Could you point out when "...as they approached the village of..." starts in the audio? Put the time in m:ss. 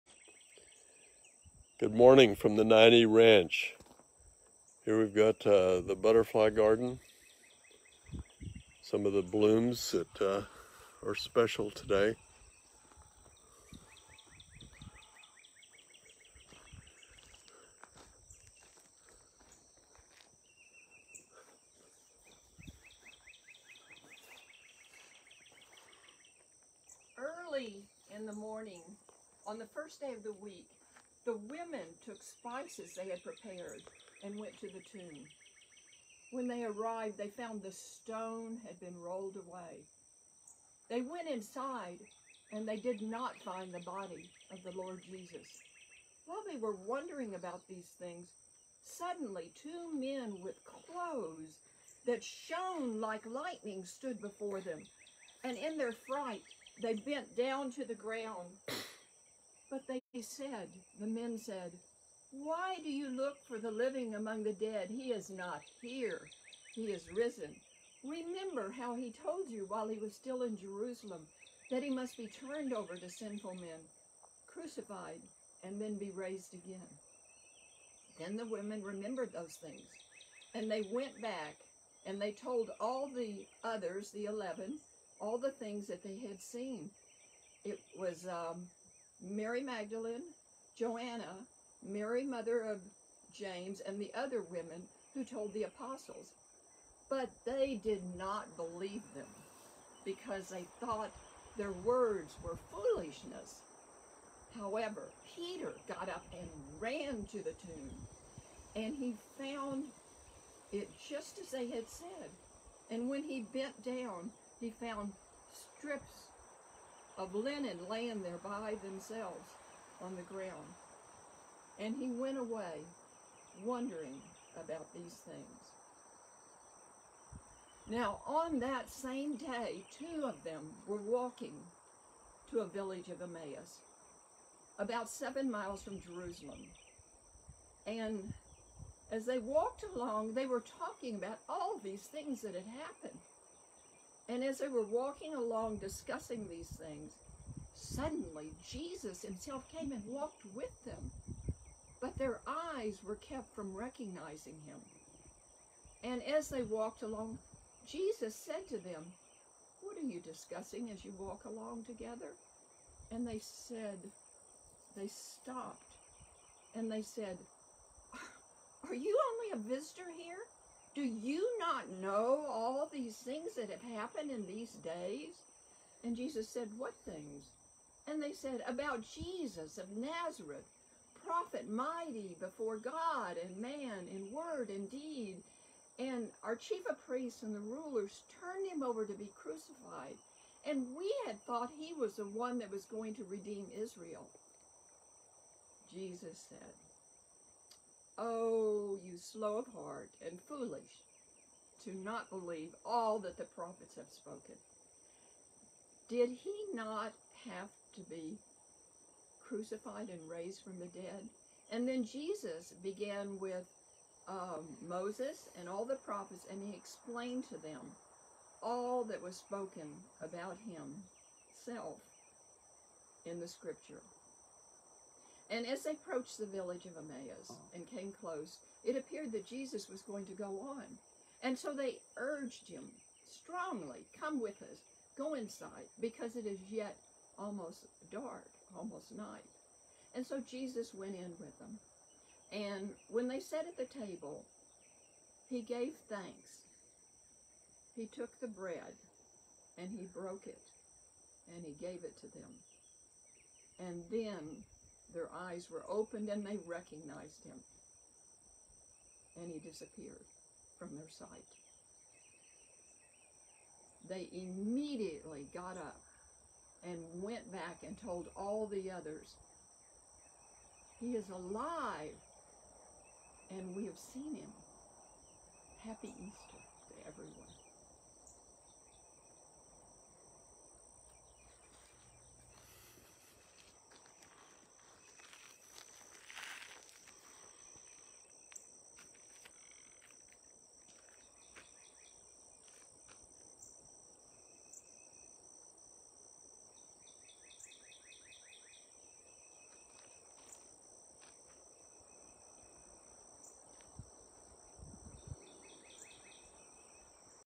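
3:45.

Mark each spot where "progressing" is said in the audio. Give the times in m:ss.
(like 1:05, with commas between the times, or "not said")
not said.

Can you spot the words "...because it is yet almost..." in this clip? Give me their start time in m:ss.
3:55.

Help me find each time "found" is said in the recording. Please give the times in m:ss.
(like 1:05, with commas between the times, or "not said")
0:37, 1:49, 1:54.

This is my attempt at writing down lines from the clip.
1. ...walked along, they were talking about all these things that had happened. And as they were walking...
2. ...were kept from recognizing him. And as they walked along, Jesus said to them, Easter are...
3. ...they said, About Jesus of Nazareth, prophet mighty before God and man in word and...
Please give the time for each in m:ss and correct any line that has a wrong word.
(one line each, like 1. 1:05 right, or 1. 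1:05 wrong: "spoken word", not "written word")
1. 2:19 right
2. 2:33 wrong: "What", not "Easter"
3. 2:58 right.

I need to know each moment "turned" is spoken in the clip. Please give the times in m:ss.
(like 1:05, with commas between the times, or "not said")
1:12, 3:08.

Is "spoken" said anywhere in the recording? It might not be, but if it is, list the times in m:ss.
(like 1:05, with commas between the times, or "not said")
3:24, 3:39.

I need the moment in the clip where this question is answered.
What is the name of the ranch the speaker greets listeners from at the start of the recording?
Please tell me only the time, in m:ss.
0:02.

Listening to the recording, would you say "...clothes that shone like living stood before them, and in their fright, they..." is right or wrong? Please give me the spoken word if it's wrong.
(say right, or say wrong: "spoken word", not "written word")
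wrong: "lightning", not "living".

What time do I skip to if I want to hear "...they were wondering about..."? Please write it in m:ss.
0:46.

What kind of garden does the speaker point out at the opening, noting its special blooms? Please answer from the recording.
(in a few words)
butterfly garden.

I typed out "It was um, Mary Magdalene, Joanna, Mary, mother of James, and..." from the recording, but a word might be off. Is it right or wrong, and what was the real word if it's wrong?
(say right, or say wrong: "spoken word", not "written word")
right.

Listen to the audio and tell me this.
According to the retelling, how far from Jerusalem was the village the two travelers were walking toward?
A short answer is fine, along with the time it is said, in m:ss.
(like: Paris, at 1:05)
7 miles, at 2:15.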